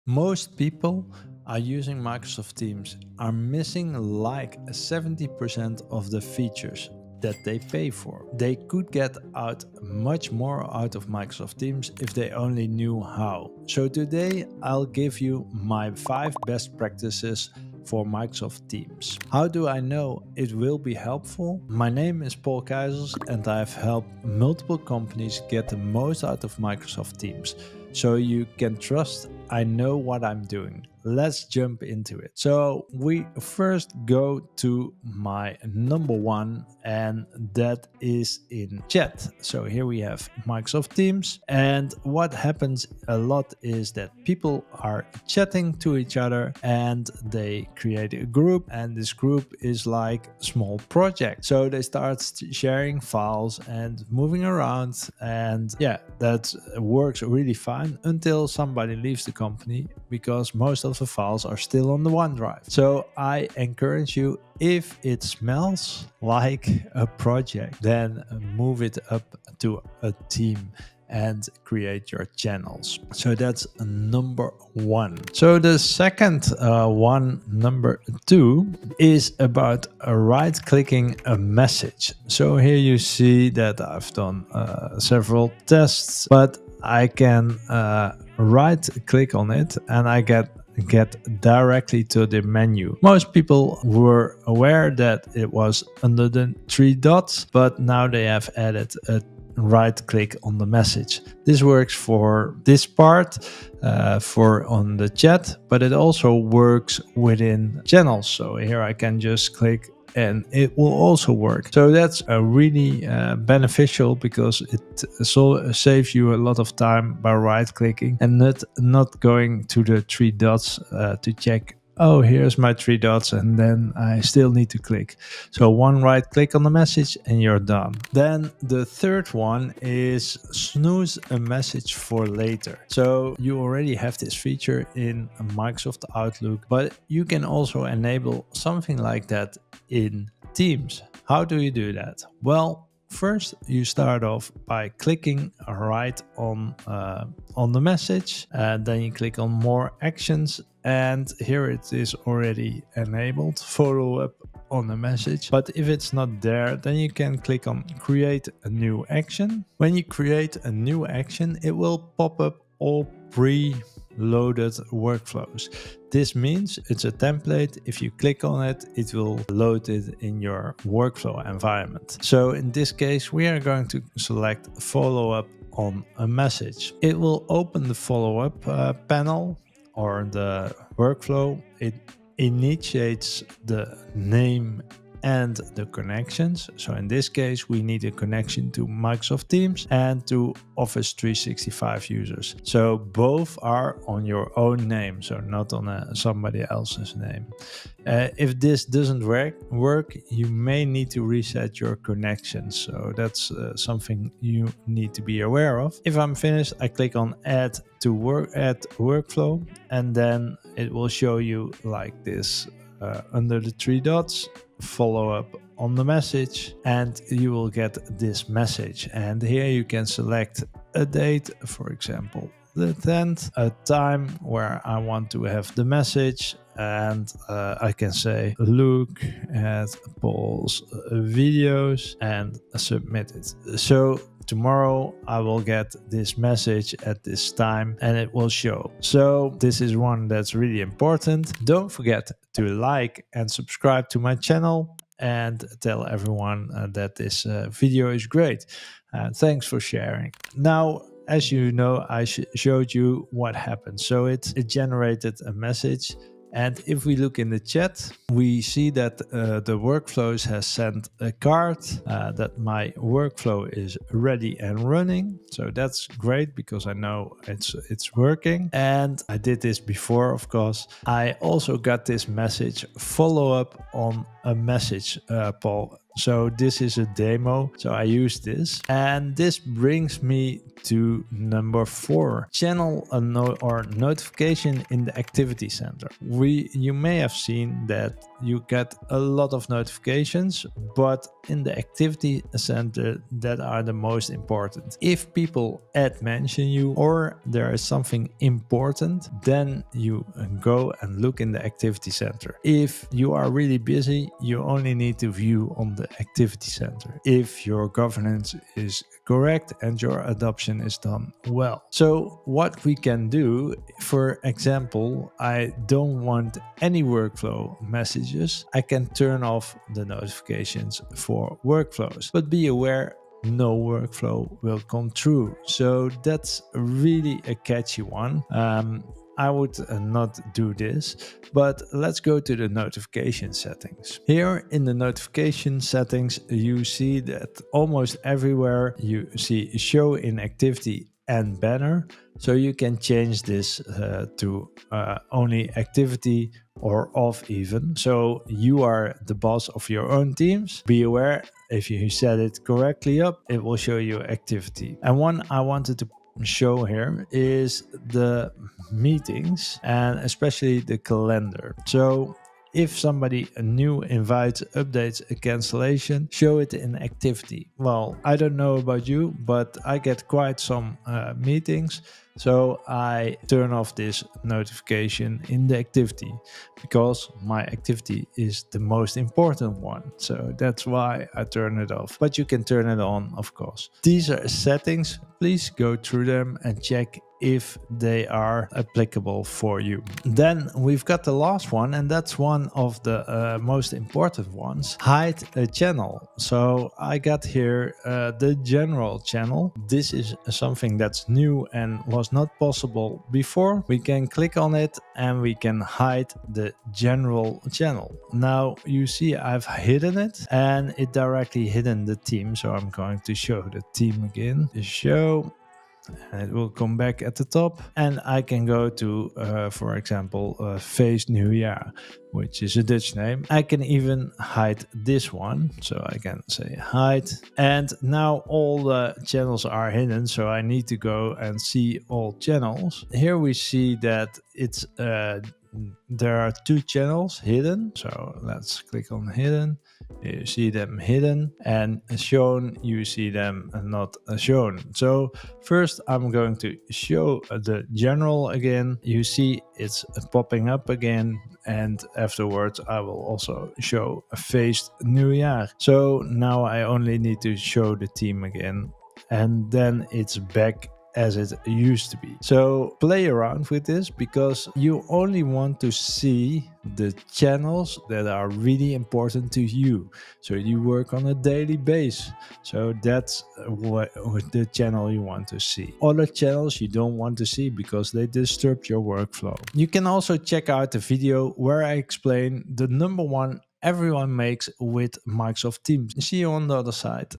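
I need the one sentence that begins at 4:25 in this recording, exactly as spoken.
So that's great because I know it's it's working.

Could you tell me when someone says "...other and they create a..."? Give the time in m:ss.
0:46.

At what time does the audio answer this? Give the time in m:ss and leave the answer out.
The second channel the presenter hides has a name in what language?
7:02.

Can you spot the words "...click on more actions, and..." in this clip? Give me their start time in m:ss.
2:29.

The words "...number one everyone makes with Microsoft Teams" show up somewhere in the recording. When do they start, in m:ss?
8:02.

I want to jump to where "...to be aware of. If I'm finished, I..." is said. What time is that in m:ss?
3:25.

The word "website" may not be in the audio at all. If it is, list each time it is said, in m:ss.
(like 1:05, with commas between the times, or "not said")
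not said.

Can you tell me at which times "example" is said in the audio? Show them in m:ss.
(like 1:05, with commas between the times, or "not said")
3:41, 5:14, 6:59.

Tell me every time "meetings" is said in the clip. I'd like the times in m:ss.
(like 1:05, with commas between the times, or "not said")
5:58, 6:11.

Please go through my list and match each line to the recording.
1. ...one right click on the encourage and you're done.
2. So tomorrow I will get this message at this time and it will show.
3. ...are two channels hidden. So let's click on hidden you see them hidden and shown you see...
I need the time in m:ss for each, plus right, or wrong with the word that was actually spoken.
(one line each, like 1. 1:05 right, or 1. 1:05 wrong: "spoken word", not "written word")
1. 2:05 wrong: "message", not "encourage"
2. 3:53 right
3. 7:16 right.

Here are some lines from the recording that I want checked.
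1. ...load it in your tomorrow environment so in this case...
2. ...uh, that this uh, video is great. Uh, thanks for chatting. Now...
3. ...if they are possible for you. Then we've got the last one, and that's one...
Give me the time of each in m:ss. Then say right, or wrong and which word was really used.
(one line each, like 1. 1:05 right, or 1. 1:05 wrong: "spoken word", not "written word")
1. 2:49 wrong: "workflow", not "tomorrow"
2. 4:06 wrong: "sharing", not "chatting"
3. 6:27 wrong: "applicable", not "possible".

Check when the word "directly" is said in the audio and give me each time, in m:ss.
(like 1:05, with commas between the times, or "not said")
1:31, 6:51.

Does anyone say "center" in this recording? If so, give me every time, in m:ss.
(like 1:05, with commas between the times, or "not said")
4:45, 4:52, 5:02, 5:06.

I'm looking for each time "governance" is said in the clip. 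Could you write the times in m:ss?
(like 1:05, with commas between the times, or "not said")
5:07.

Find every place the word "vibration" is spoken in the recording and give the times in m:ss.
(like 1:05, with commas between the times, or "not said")
not said.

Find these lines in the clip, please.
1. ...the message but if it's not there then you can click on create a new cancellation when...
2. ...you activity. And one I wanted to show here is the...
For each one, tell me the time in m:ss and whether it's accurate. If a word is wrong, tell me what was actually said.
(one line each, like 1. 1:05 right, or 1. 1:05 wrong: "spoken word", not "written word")
1. 2:34 wrong: "action", not "cancellation"
2. 5:53 right.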